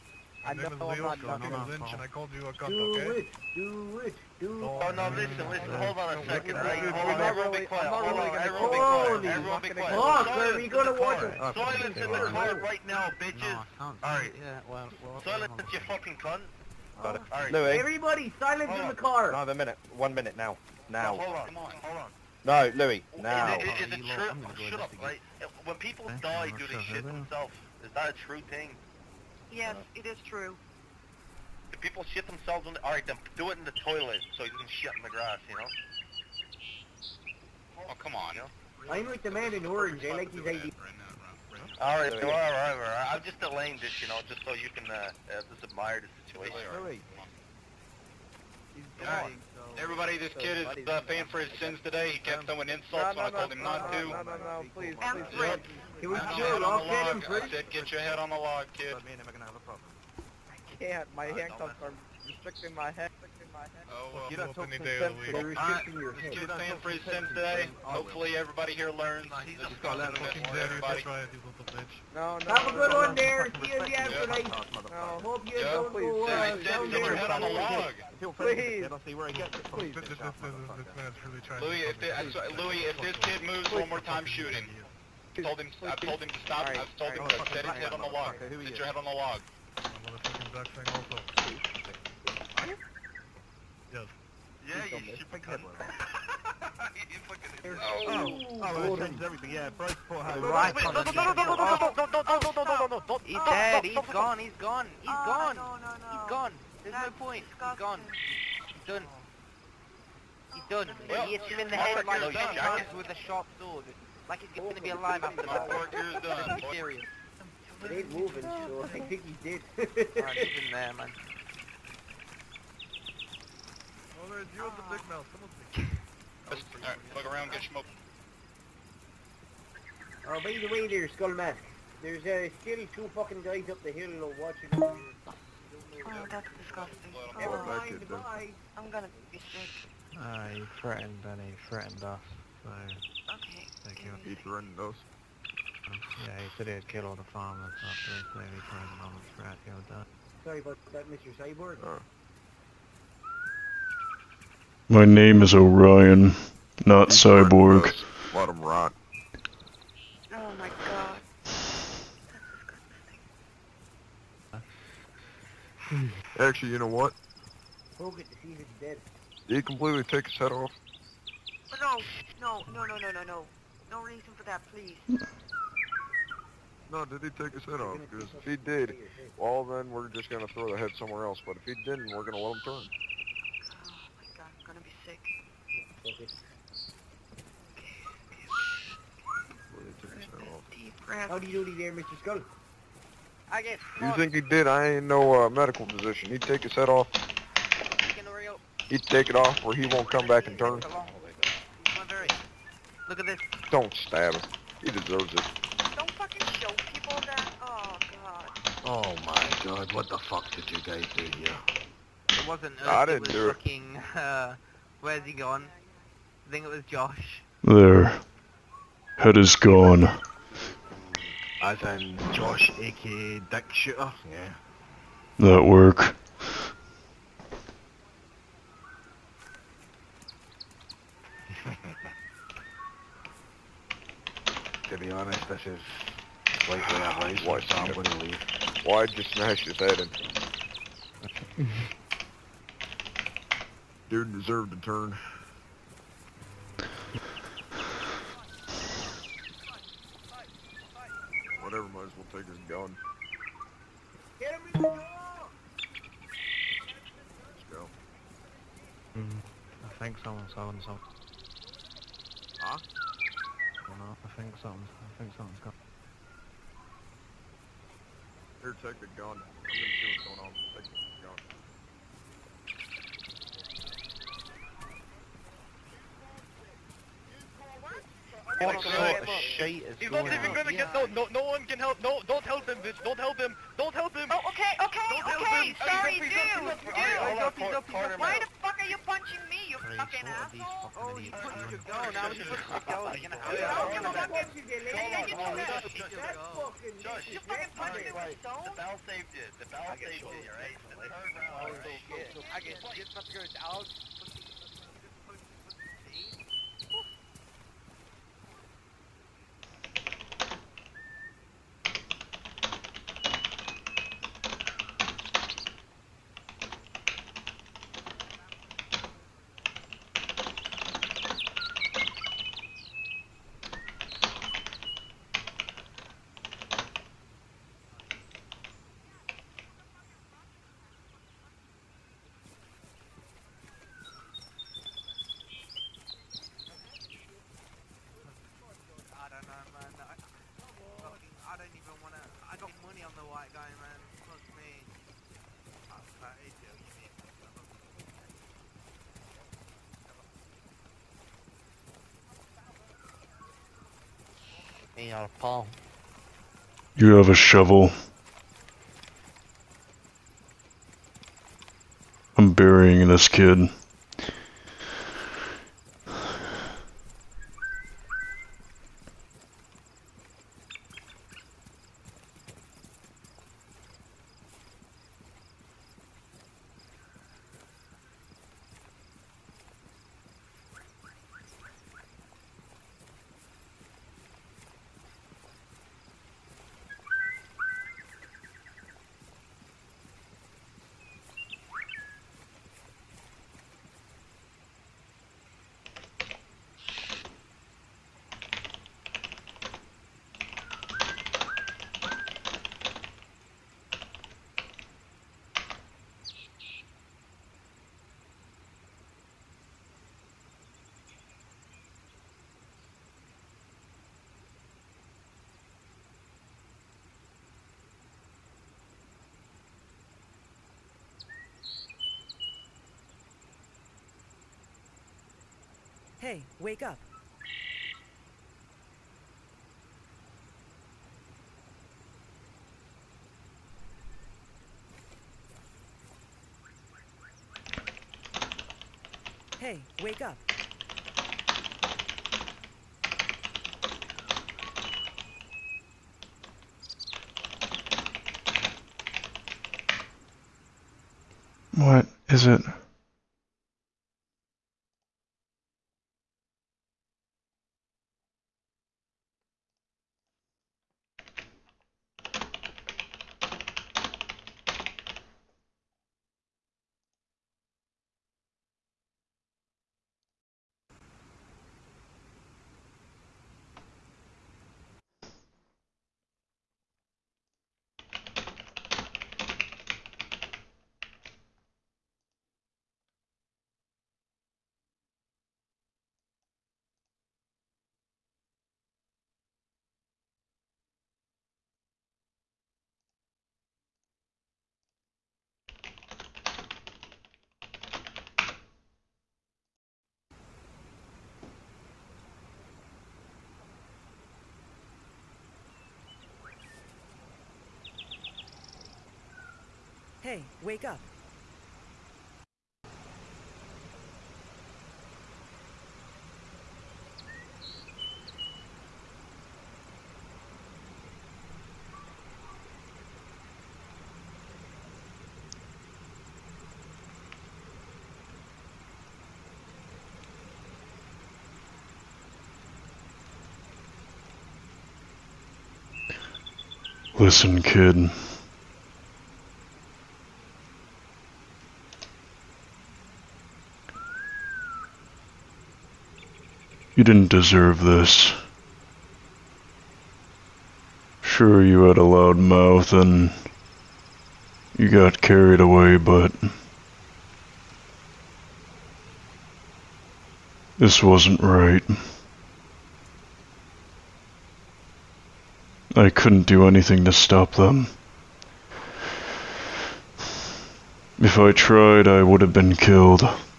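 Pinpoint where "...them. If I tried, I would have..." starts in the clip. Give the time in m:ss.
9:27.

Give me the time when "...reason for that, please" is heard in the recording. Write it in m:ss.
2:54.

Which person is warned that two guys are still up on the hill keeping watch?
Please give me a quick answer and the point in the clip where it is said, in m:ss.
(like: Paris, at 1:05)
Skull Mask, at 2:11.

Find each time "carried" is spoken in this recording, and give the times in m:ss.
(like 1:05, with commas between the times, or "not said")
9:15.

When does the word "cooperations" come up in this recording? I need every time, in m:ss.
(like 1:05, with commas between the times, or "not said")
not said.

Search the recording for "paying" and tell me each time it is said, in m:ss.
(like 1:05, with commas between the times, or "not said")
0:51.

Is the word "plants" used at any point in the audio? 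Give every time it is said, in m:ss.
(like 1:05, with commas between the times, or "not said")
not said.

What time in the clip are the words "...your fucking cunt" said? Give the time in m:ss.
0:15.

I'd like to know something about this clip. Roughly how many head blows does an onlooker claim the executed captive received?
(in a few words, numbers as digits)
10.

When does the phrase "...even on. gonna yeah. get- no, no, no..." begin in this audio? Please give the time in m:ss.
4:40.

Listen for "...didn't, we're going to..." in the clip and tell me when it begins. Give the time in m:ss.
3:01.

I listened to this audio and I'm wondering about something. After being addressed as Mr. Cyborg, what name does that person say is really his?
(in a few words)
Orion.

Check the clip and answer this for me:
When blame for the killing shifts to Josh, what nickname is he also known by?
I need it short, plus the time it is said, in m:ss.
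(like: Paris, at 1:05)
Dick Shooter, at 3:43.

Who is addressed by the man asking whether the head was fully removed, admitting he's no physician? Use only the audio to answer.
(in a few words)
Mr. Scott.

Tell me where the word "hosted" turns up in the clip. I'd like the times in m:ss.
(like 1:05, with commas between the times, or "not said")
not said.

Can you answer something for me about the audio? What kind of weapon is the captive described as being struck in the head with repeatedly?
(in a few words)
sharp sword.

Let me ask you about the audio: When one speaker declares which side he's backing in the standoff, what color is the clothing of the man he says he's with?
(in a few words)
orange.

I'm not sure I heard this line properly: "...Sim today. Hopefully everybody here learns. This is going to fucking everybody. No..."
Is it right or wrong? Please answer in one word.
right.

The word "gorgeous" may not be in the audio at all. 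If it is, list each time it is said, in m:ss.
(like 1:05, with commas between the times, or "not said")
not said.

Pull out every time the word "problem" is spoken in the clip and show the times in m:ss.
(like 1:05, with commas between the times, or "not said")
0:59.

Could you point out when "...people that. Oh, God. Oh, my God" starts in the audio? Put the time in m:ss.
3:26.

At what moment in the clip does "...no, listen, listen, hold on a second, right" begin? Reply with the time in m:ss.
0:04.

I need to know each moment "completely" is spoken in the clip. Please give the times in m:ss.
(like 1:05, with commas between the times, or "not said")
2:49.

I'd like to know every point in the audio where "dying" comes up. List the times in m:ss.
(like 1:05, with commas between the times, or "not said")
0:49.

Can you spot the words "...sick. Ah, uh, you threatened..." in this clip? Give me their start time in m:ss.
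2:19.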